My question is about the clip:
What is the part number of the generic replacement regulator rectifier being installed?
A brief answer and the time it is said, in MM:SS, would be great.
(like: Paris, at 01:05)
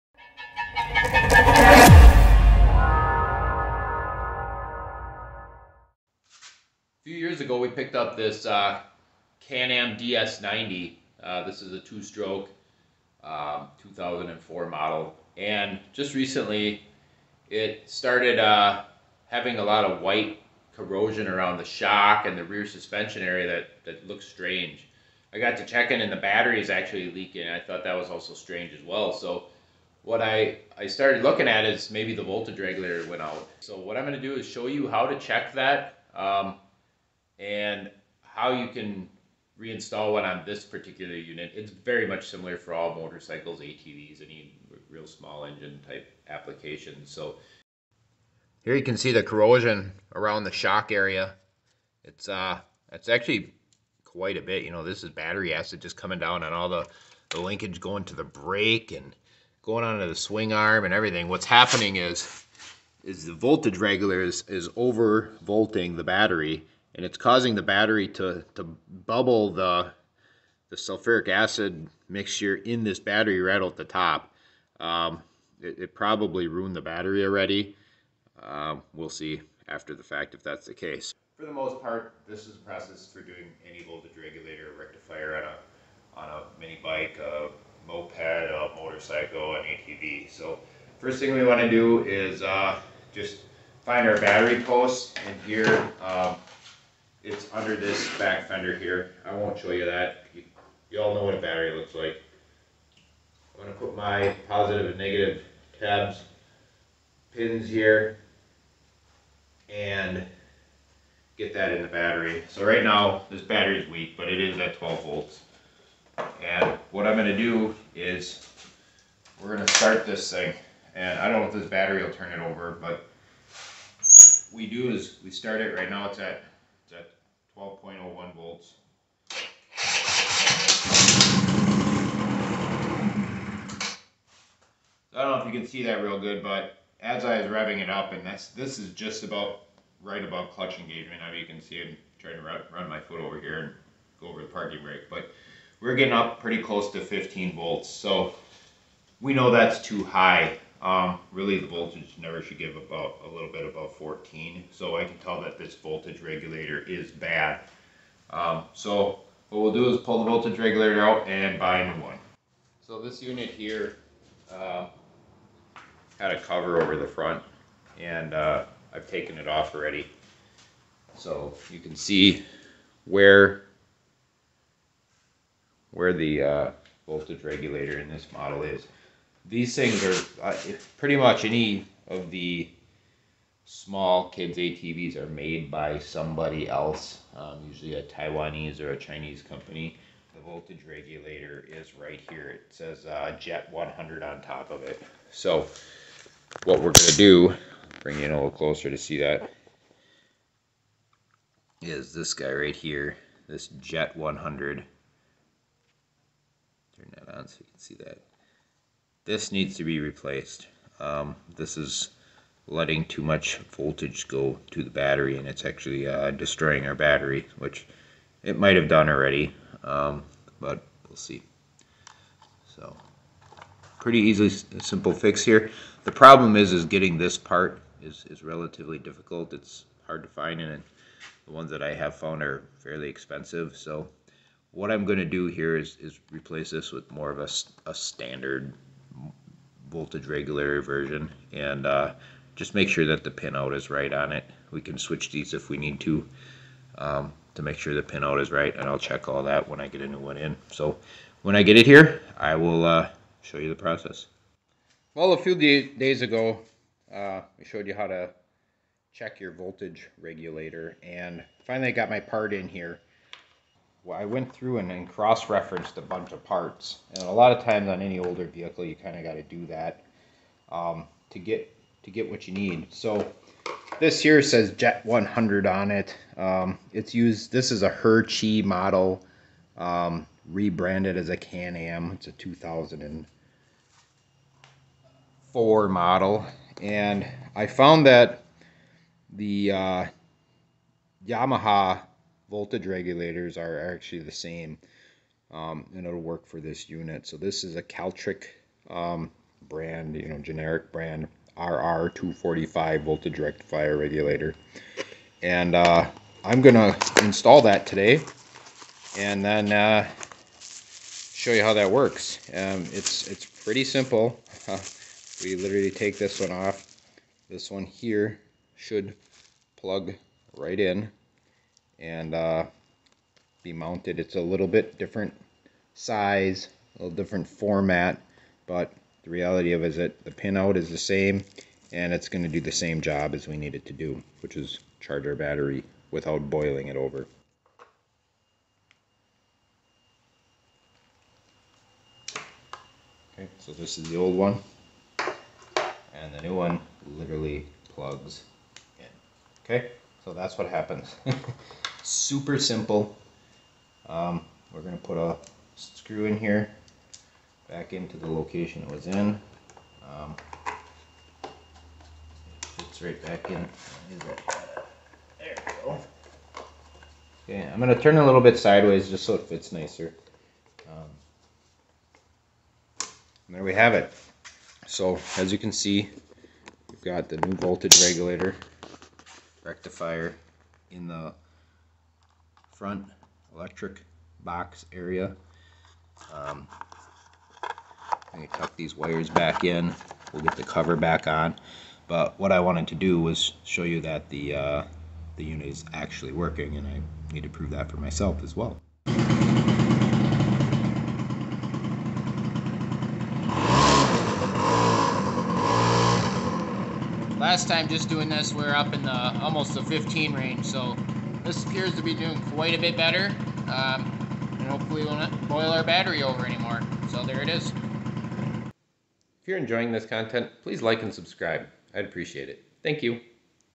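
RR245, at 05:01.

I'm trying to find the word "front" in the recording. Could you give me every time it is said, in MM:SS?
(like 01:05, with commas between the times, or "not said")
02:47, 06:22.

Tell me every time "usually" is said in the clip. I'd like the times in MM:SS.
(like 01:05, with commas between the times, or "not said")
03:07.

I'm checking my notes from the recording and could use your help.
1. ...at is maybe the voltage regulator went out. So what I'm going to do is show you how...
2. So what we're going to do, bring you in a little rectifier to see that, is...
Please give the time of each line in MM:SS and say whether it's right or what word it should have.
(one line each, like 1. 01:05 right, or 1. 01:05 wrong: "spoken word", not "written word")
1. 00:31 right
2. 03:15 wrong: "closer", not "rectifier".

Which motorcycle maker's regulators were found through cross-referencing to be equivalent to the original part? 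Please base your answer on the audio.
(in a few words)
Yamaha.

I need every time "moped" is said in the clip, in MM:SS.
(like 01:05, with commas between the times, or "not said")
01:27.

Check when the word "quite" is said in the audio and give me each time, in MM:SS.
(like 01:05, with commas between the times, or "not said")
00:54, 06:52.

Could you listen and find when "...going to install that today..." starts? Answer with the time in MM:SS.
05:06.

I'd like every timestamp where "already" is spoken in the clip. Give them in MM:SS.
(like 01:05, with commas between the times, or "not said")
01:17, 02:49, 03:39.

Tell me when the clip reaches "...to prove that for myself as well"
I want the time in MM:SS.
06:37.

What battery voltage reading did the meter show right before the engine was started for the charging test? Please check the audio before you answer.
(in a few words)
12.01 volts.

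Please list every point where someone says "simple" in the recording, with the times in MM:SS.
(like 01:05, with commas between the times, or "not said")
03:44, 05:13, 05:52.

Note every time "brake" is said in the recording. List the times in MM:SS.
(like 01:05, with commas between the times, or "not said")
00:58, 02:24.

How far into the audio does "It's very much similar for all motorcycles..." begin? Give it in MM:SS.
00:41.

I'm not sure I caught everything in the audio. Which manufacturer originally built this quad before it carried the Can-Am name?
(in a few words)
Her Chee.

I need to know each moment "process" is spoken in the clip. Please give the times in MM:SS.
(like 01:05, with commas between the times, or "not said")
01:22, 04:13.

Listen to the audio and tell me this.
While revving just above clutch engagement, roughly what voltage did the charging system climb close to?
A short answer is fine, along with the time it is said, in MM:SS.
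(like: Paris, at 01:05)
15 volts, at 02:27.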